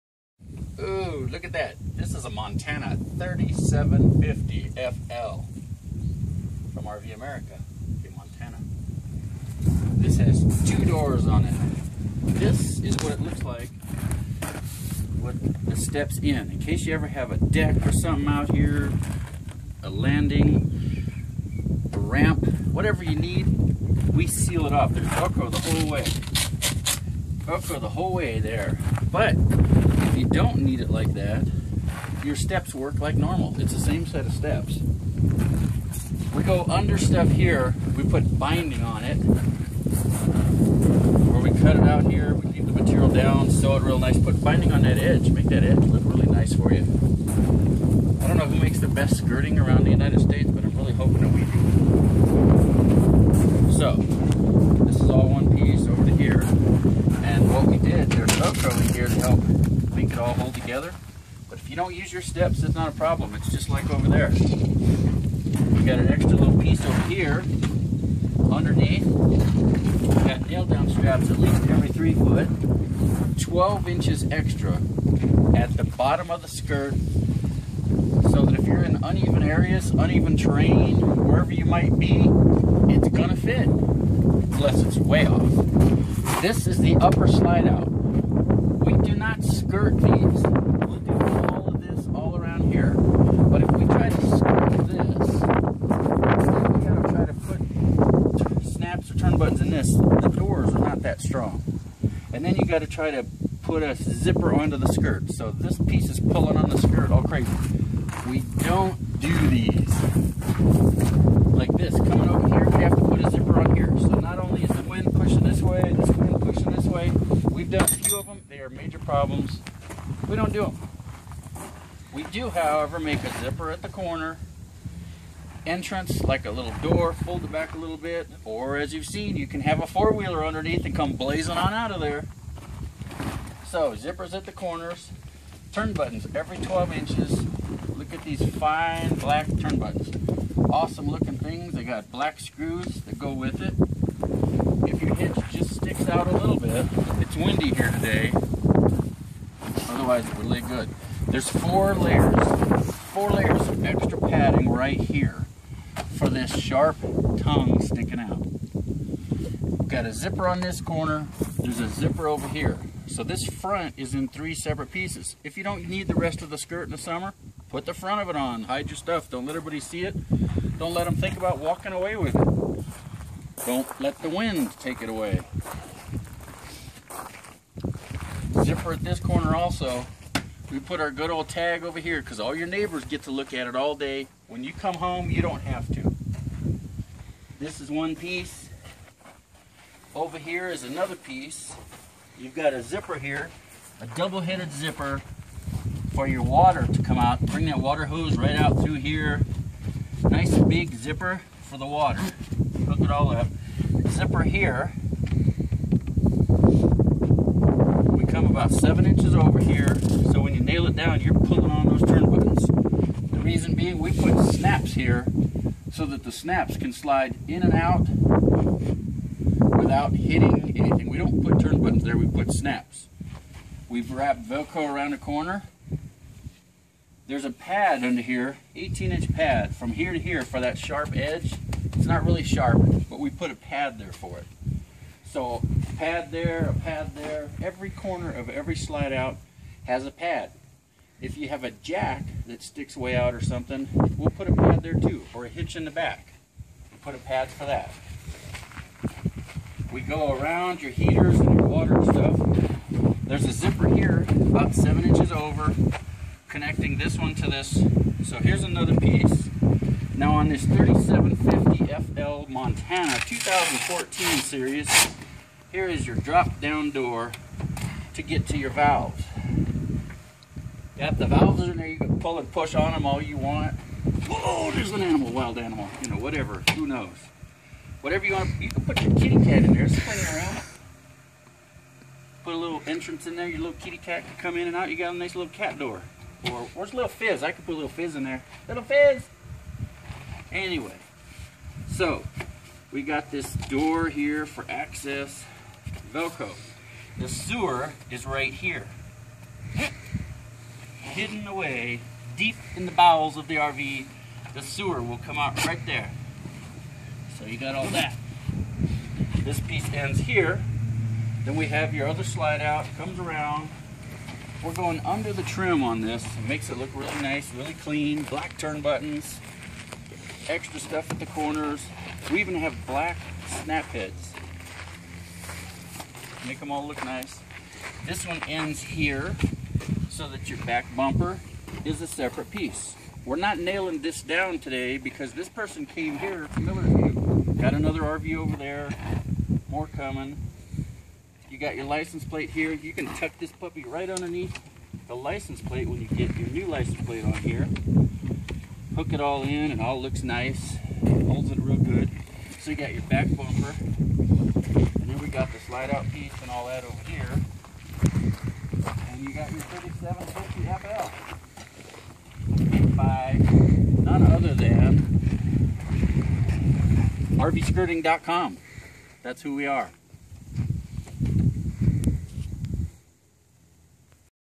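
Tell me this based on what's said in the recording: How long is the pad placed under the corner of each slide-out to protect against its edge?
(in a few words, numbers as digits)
18 inches.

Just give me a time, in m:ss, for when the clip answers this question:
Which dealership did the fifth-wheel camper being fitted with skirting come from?
0:06.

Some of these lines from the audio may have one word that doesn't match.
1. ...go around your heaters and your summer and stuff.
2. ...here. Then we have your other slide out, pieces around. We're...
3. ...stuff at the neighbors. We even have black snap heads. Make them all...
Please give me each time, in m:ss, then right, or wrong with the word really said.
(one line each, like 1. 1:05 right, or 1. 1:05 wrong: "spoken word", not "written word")
1. 4:10 wrong: "water", not "summer"
2. 5:10 wrong: "comes", not "pieces"
3. 5:20 wrong: "corners", not "neighbors".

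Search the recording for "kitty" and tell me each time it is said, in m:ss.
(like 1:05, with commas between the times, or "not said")
4:39, 4:43.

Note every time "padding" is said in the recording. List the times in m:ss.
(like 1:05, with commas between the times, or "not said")
2:34.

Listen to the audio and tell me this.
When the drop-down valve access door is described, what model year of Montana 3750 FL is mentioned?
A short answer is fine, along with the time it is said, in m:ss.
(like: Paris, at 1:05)
2014, at 4:23.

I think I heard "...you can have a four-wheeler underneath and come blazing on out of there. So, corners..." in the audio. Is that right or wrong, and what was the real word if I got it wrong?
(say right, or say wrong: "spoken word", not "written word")
wrong: "zippers", not "corners".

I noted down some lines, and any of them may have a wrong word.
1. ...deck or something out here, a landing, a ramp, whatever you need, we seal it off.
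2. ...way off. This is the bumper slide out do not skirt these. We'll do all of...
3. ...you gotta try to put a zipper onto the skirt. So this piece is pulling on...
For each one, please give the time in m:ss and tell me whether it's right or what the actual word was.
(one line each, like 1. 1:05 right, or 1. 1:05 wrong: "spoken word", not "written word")
1. 0:17 right
2. 1:24 wrong: "upper", not "bumper"
3. 1:42 right.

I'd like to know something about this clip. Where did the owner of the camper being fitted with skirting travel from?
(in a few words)
Millerview.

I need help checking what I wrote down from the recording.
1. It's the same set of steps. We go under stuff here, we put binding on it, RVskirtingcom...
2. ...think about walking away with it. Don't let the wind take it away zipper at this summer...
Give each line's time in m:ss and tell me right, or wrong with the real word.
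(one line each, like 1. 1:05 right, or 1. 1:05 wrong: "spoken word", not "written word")
1. 0:33 wrong: "Where", not "RVskirtingcom"
2. 2:51 wrong: "corner", not "summer".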